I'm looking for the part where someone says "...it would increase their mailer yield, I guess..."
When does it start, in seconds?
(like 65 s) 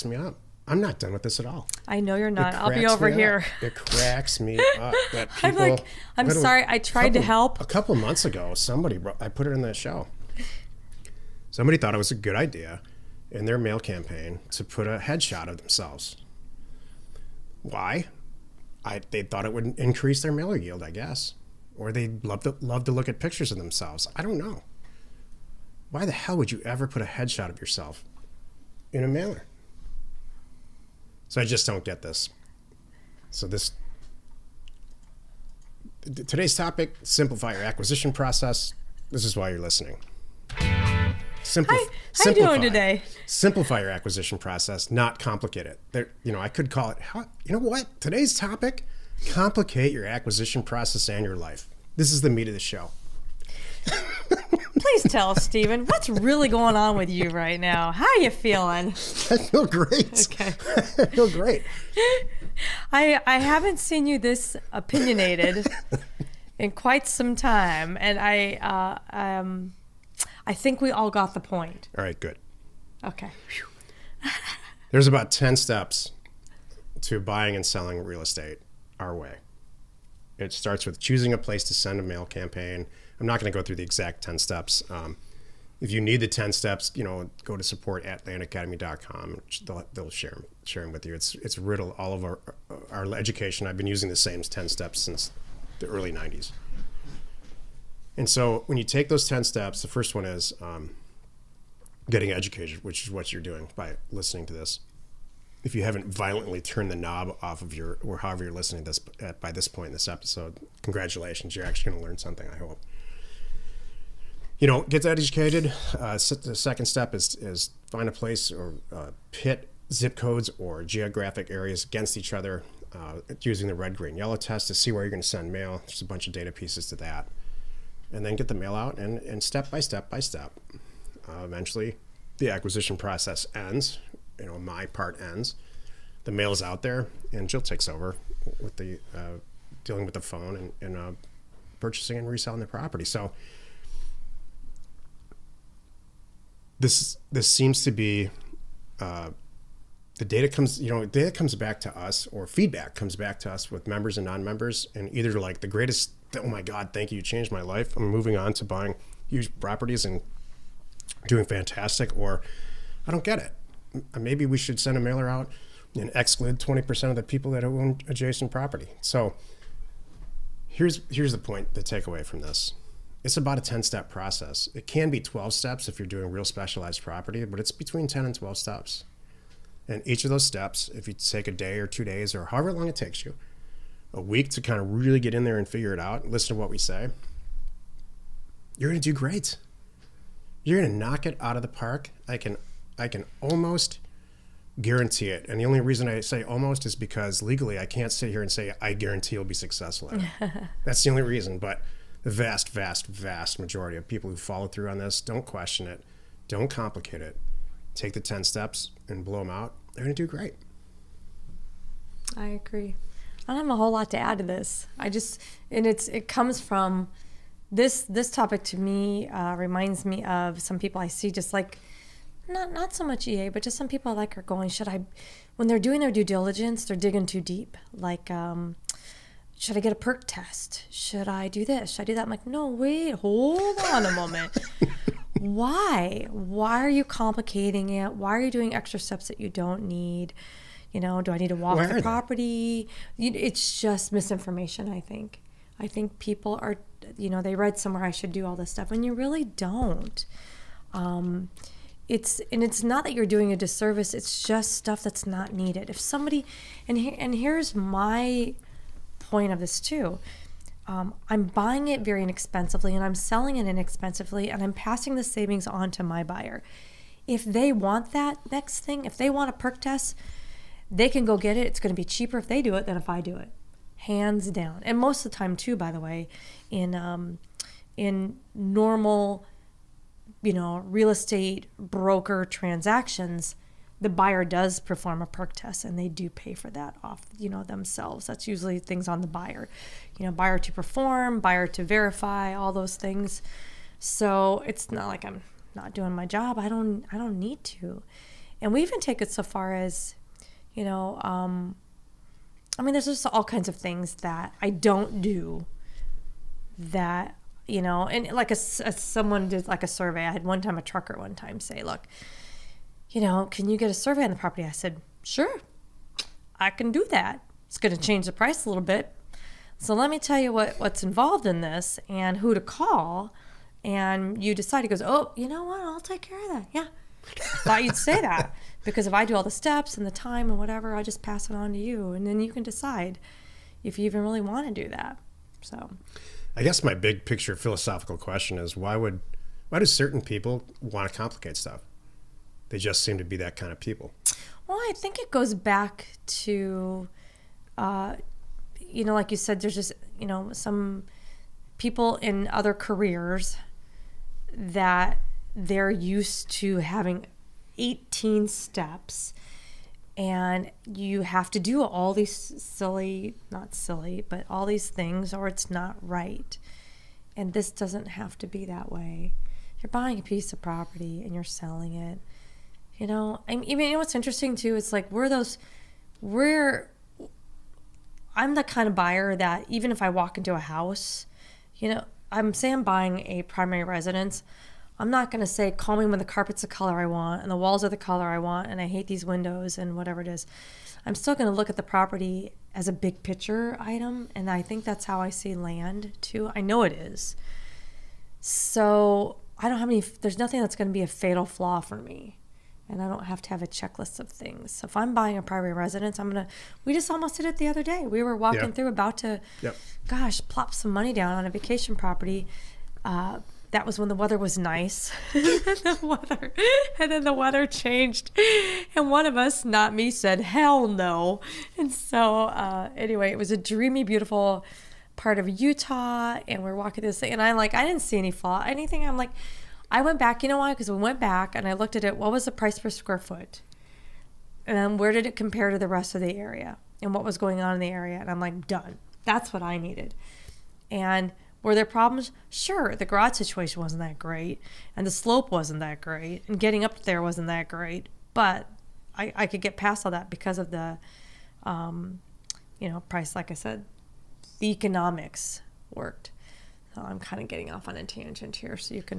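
19 s.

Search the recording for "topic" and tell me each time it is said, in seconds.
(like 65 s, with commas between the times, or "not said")
36 s, 48 s, 218 s.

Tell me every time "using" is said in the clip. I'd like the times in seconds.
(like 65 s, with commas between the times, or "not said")
93 s, 123 s.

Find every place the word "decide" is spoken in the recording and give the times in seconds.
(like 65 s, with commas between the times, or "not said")
324 s, 332 s.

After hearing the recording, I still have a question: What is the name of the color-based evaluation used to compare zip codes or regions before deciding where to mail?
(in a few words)
red, green, yellow test.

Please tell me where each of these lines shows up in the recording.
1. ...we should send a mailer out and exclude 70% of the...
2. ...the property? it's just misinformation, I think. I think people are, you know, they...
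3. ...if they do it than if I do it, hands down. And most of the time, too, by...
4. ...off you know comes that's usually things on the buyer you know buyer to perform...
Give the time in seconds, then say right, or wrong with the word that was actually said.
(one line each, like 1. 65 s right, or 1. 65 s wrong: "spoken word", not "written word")
1. 164 s wrong: "20", not "70"
2. 241 s right
3. 272 s right
4. 287 s wrong: "themselves", not "comes".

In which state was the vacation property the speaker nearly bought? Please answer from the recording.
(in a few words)
Utah.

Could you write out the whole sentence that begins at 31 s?
So I just don't get this.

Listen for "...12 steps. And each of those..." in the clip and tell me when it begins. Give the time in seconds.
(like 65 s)
178 s.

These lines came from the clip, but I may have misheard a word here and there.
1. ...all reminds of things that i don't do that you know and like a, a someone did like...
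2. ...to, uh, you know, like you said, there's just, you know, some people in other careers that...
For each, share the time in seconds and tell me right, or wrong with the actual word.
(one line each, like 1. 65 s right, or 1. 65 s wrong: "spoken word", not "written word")
1. 303 s wrong: "kinds", not "reminds"
2. 346 s right.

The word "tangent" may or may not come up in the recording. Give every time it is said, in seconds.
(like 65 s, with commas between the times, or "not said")
458 s.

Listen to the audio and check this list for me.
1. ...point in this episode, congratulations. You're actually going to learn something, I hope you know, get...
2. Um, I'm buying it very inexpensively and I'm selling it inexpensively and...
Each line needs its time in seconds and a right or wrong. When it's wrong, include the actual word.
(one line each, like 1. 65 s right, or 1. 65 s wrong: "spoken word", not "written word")
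1. 109 s right
2. 260 s right.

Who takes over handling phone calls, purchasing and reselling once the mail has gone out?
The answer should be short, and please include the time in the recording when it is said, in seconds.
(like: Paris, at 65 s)
Jill, at 137 s.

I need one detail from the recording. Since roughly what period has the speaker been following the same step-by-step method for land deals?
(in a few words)
the early 90s.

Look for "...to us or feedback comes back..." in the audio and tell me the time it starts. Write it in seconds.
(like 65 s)
151 s.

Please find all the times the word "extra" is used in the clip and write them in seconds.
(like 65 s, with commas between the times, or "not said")
238 s.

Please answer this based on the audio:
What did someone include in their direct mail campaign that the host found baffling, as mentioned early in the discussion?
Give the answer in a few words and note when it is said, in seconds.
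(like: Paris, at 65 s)
a headshot of themselves, at 14 s.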